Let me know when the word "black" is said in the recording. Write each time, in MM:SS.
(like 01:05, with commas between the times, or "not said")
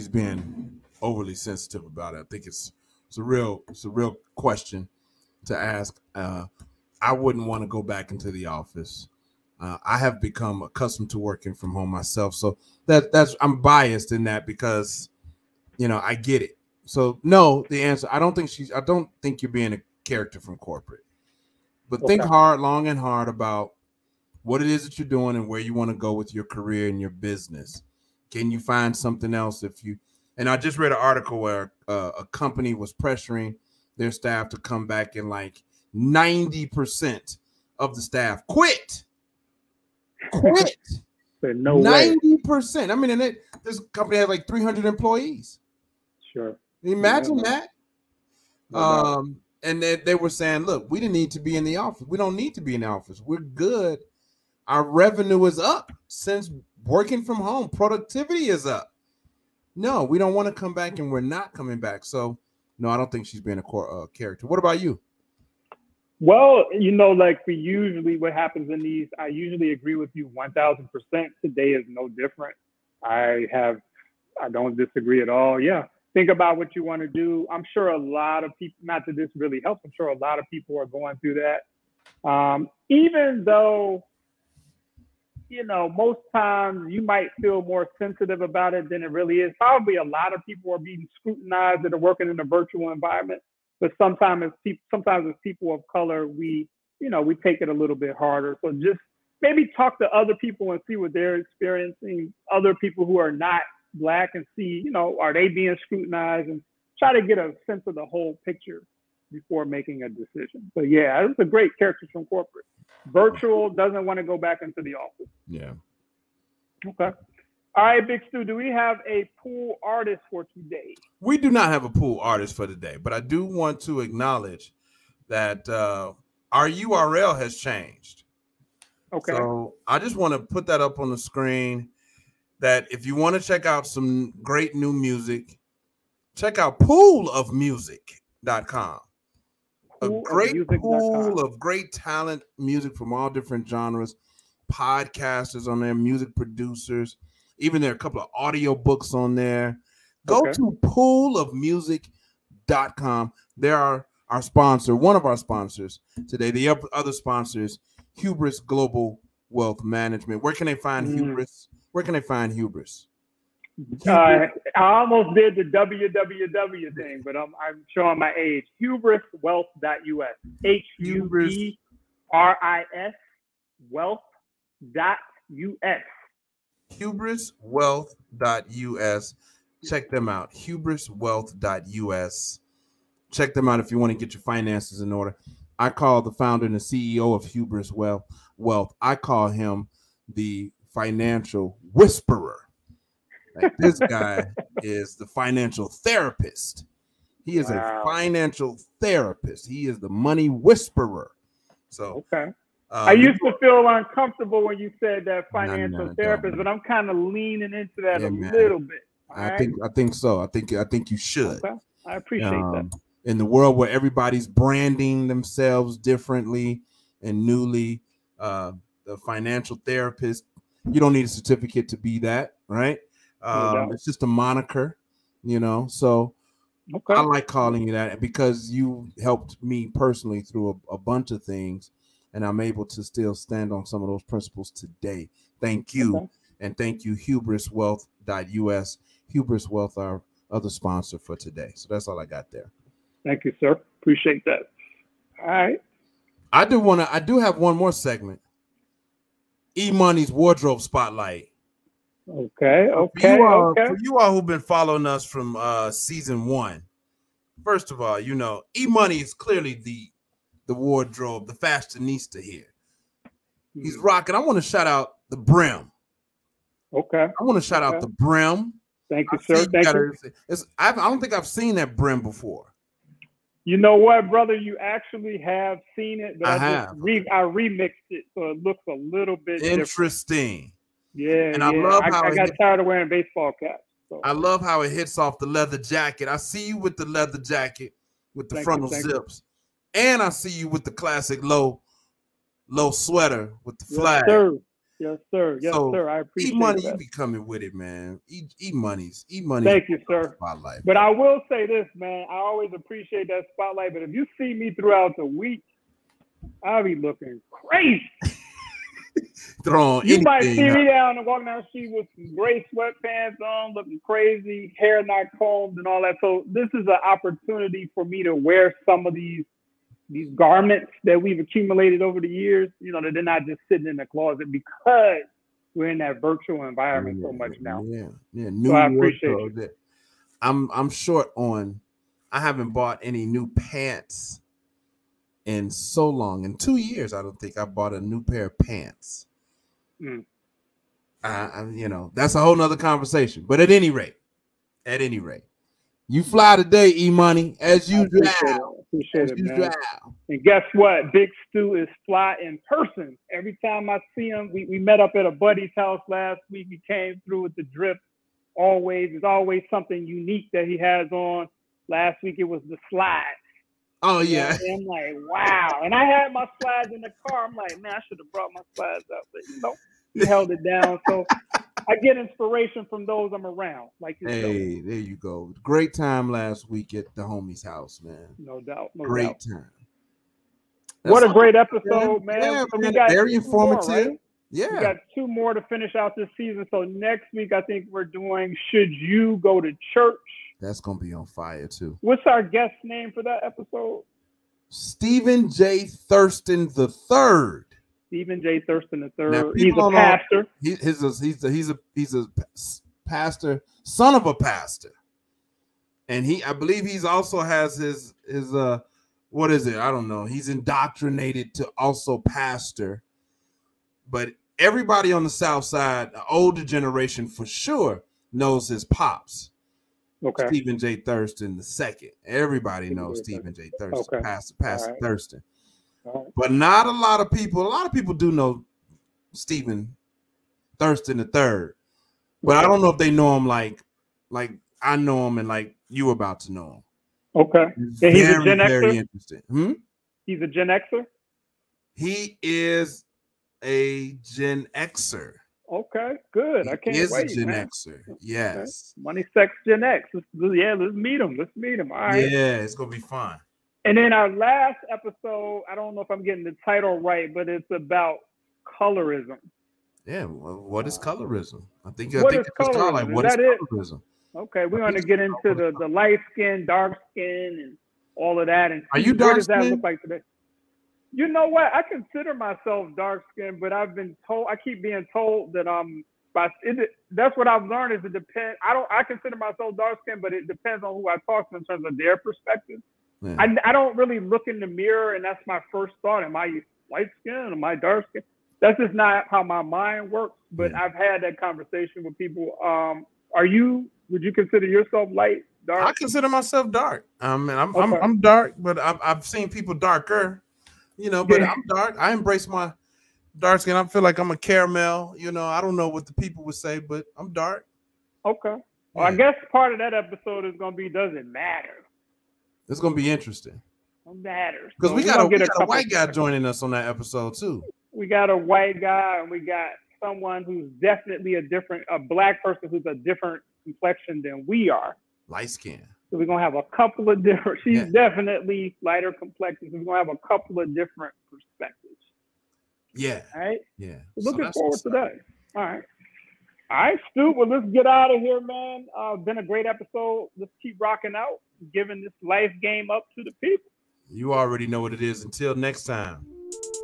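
01:43, 08:41.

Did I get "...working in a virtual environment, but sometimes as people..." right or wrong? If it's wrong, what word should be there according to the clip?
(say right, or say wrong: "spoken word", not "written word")
right.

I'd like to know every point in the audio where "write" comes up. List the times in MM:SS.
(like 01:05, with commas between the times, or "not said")
not said.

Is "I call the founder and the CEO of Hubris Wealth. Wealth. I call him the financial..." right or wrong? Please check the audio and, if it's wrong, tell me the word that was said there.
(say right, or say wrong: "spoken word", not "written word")
right.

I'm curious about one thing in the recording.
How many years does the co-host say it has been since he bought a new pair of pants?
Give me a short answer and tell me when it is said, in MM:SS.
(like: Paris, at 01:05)
2, at 05:36.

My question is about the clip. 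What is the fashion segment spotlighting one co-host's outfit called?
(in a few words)
E Money's wardrobe spotlight.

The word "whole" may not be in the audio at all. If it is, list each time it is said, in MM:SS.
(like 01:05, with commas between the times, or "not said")
01:48, 05:42.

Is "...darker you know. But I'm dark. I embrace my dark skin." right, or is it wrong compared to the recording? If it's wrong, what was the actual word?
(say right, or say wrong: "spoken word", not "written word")
right.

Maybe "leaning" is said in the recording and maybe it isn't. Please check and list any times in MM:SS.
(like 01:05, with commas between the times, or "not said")
03:27.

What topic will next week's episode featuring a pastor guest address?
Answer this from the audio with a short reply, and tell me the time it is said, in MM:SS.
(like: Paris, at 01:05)
should you go to church, at 06:28.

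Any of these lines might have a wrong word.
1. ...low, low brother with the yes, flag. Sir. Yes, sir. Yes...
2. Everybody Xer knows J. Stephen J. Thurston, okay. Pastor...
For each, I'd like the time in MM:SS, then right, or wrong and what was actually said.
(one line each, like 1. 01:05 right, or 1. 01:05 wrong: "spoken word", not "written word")
1. 04:51 wrong: "sweater", not "brother"
2. 07:02 wrong: "Stephen", not "Xer".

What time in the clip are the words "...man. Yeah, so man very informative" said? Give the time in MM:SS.
06:22.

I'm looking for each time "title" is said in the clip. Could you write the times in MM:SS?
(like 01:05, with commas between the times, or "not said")
07:36.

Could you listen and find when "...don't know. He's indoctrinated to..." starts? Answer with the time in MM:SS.
06:49.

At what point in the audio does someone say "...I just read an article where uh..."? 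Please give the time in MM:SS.
00:30.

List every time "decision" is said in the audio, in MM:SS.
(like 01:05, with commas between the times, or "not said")
01:50.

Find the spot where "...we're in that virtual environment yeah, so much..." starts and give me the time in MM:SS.
05:25.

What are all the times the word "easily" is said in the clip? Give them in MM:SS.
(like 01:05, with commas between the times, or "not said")
not said.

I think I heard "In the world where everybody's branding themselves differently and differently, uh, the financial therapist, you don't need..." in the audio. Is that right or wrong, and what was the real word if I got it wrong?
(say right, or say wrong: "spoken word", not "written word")
wrong: "newly", not "differently".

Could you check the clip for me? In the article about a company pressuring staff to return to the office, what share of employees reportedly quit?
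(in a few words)
90%.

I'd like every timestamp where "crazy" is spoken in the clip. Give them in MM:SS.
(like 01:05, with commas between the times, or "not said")
05:07, 05:14.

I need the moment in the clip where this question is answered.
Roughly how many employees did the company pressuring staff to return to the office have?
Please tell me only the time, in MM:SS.
00:44.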